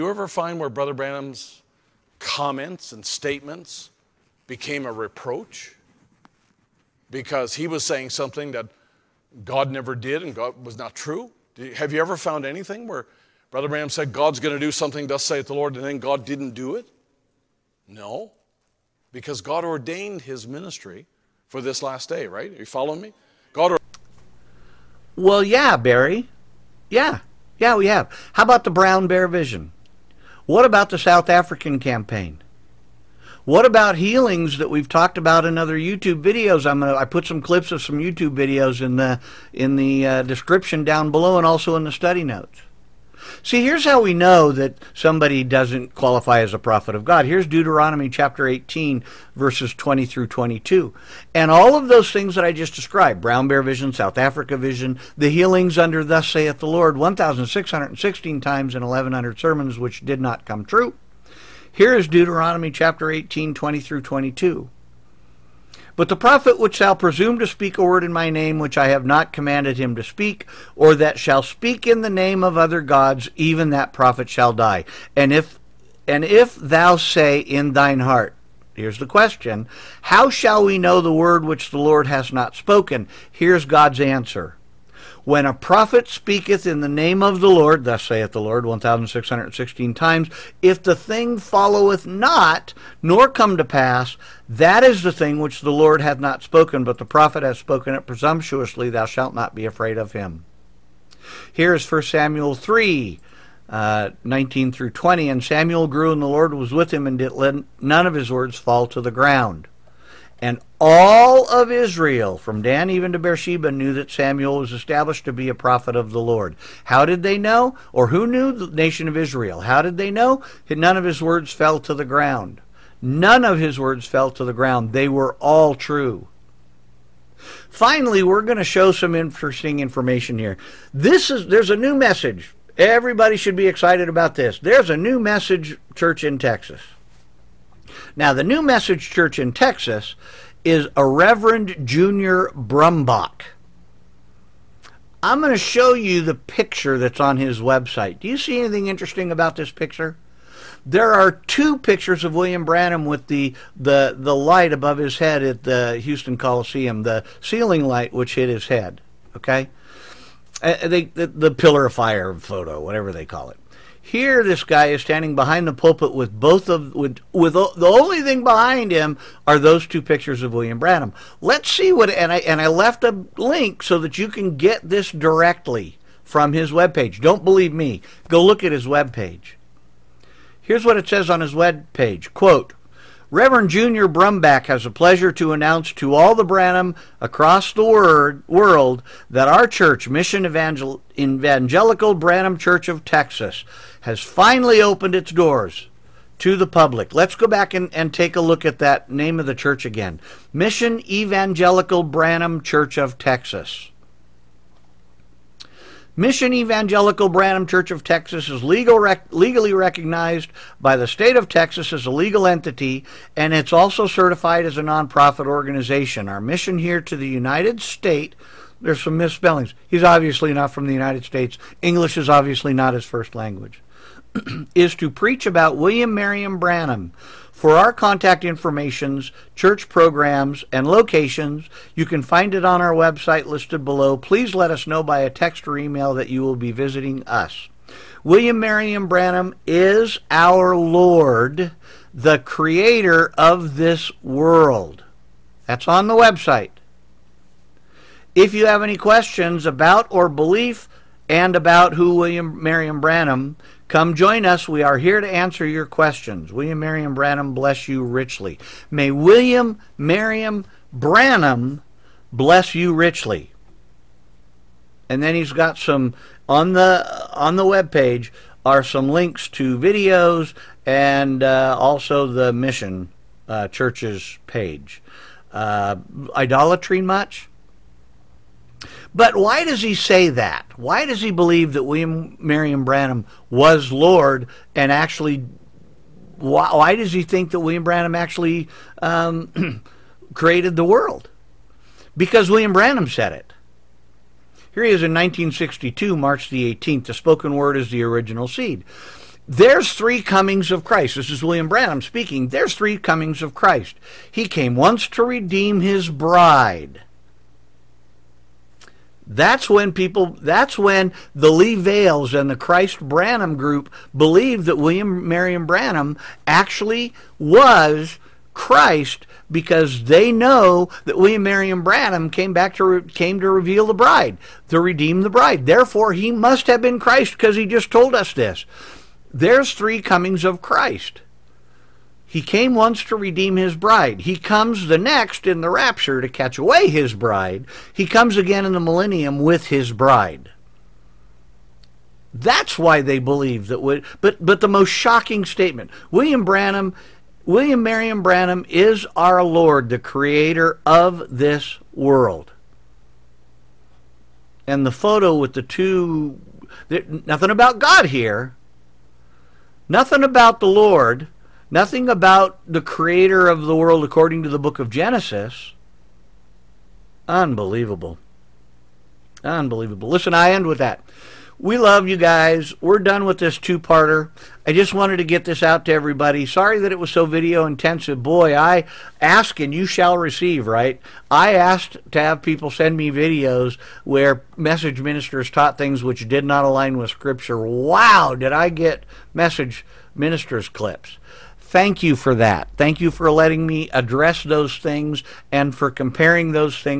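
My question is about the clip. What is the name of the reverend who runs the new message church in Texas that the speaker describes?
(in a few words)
Junior Brumbach.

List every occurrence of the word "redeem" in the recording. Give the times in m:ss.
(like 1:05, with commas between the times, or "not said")
5:05, 5:24, 5:33.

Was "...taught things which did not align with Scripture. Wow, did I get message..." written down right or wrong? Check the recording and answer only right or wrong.
right.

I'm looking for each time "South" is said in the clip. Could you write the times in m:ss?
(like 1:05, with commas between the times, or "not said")
0:30, 0:53.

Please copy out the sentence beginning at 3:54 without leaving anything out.
Please let us know by a text or email that you will be visiting us.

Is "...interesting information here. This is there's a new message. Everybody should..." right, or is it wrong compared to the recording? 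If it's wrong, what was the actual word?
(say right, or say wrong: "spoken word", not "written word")
right.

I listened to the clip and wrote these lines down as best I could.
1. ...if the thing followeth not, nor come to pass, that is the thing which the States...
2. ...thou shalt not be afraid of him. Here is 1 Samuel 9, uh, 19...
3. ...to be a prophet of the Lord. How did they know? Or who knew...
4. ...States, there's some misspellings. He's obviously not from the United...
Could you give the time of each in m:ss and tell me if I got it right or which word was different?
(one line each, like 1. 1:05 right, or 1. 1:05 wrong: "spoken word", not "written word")
1. 1:30 wrong: "Lord", not "States"
2. 1:38 wrong: "3", not "9"
3. 1:55 right
4. 3:37 right.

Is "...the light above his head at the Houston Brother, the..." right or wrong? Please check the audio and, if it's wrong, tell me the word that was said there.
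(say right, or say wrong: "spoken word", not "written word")
wrong: "Coliseum", not "Brother".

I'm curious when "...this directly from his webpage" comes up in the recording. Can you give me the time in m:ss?
2:54.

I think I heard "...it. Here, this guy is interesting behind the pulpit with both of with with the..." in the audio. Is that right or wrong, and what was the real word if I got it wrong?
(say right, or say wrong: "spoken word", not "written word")
wrong: "standing", not "interesting".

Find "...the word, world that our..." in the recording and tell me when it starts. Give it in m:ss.
3:07.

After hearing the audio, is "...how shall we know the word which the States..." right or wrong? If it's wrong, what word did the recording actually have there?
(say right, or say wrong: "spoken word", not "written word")
wrong: "Lord", not "States".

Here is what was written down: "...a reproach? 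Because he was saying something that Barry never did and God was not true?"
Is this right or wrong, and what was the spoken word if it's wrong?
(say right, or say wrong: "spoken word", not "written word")
wrong: "God", not "Barry".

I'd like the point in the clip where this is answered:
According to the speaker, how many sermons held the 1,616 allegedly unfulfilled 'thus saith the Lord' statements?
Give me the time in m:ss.
0:58.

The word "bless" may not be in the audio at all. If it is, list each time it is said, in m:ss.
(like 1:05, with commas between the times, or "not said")
4:17, 4:22.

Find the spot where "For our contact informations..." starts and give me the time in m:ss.
3:47.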